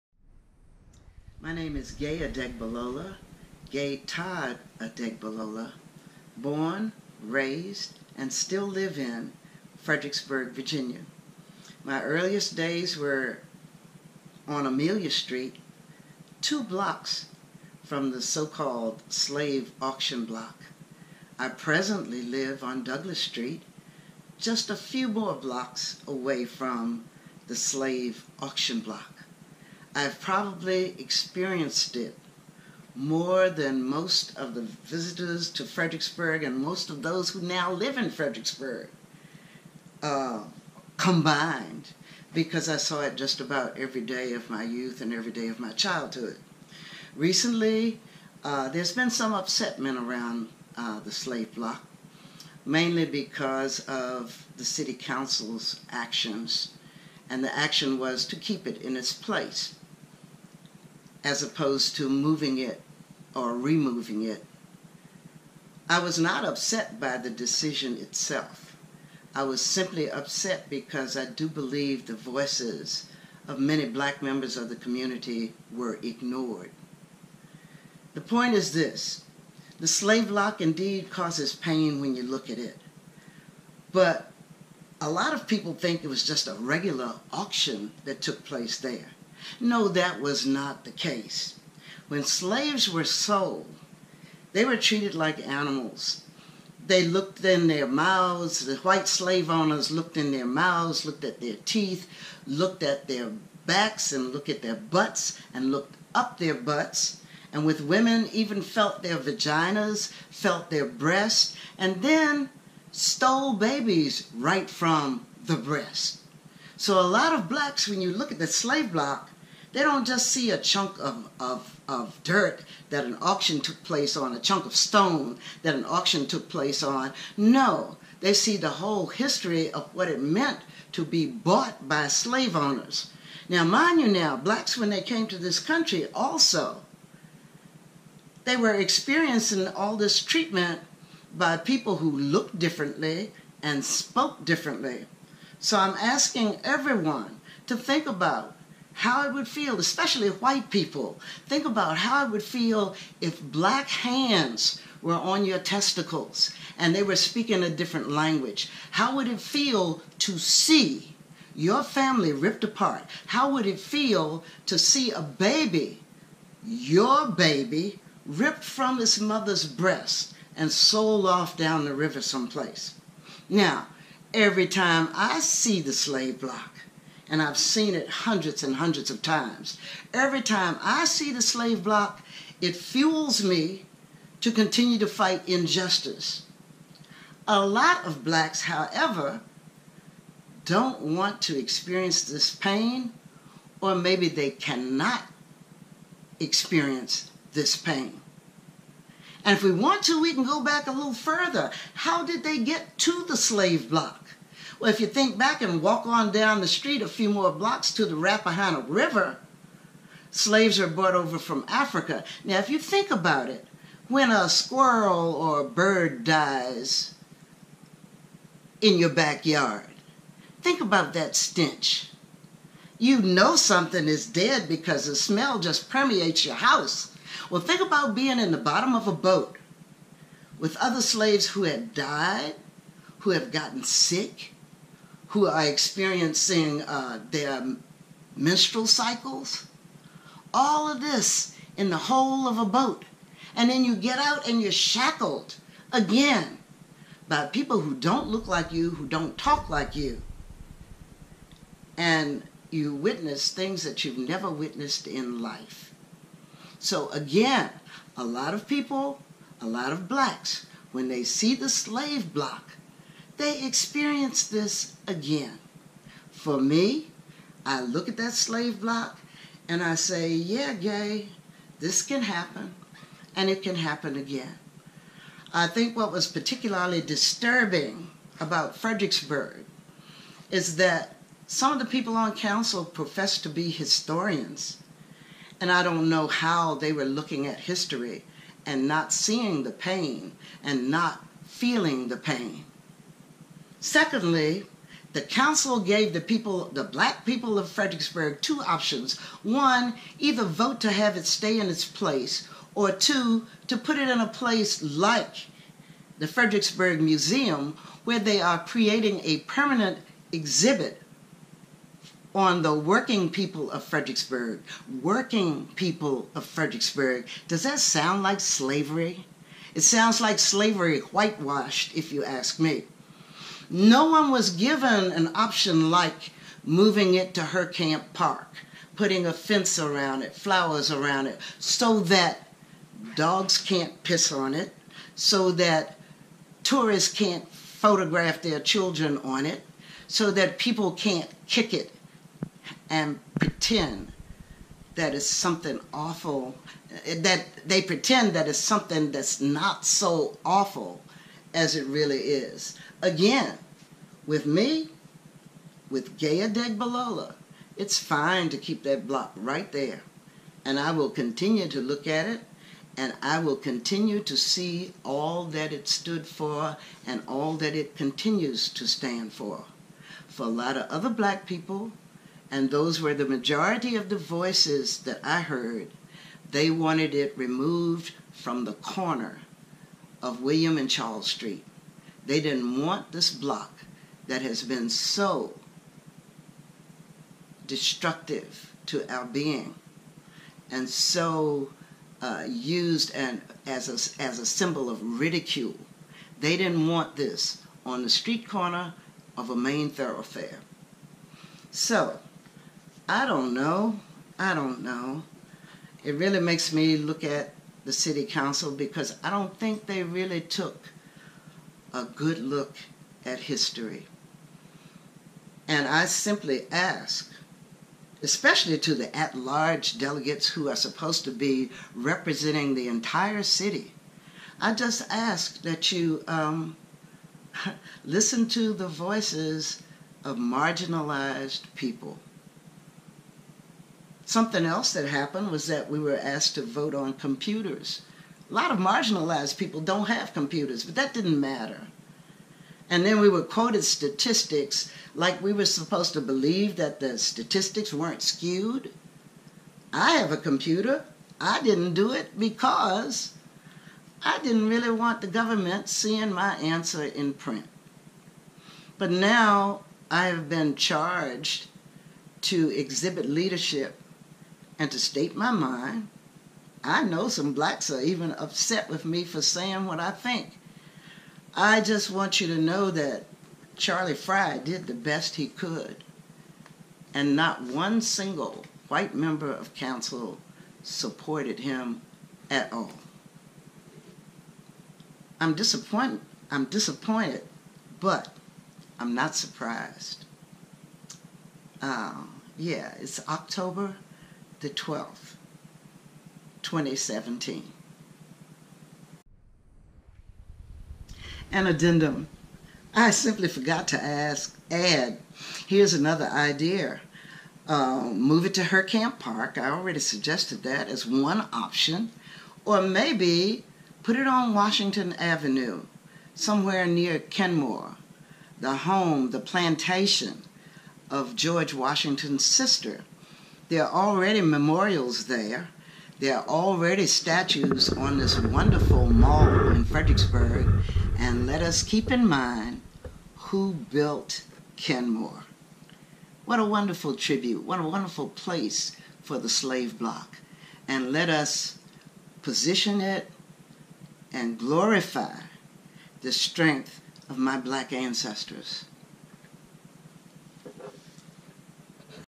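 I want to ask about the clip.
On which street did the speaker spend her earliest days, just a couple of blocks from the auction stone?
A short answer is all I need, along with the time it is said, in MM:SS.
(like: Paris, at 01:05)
Amelia Street, at 00:14.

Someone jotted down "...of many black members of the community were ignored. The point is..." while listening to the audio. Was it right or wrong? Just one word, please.
right.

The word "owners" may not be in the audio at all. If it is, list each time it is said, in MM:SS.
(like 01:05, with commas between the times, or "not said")
01:39, 02:12.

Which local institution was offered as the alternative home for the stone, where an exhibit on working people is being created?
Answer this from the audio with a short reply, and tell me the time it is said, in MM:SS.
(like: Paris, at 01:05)
Fredericksburg Museum, at 05:06.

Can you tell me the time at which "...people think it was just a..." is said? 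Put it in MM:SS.
01:25.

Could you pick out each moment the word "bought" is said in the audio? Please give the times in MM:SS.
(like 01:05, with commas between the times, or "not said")
02:11.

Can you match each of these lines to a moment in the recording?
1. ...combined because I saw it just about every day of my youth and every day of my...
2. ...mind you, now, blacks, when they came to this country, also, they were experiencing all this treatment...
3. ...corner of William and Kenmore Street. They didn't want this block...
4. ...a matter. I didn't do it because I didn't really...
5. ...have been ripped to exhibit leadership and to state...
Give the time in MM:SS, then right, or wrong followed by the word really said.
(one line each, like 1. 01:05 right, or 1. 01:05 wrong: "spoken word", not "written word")
1. 00:40 right
2. 02:13 right
3. 06:18 wrong: "Charles", not "Kenmore"
4. 07:30 wrong: "computer", not "matter"
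5. 07:40 wrong: "charged", not "ripped".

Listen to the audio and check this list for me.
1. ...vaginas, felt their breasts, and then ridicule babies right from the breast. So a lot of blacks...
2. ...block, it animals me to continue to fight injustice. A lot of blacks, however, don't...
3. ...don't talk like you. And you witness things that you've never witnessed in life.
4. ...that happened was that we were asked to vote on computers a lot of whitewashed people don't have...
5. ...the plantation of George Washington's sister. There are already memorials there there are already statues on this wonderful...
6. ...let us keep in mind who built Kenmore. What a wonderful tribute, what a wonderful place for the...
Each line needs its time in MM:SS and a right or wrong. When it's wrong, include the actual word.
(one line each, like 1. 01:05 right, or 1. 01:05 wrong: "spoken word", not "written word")
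1. 01:49 wrong: "stole", not "ridicule"
2. 03:01 wrong: "fuels", not "animals"
3. 04:09 right
4. 07:14 wrong: "marginalized", not "whitewashed"
5. 08:39 right
6. 08:51 right.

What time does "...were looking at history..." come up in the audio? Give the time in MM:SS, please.
04:46.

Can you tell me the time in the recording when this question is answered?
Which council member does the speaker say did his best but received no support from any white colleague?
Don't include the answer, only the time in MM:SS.
07:53.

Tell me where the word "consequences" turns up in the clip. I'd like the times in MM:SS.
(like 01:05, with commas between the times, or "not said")
not said.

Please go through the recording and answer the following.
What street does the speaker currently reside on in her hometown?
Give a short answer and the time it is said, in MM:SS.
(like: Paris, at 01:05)
Douglas Street, at 00:22.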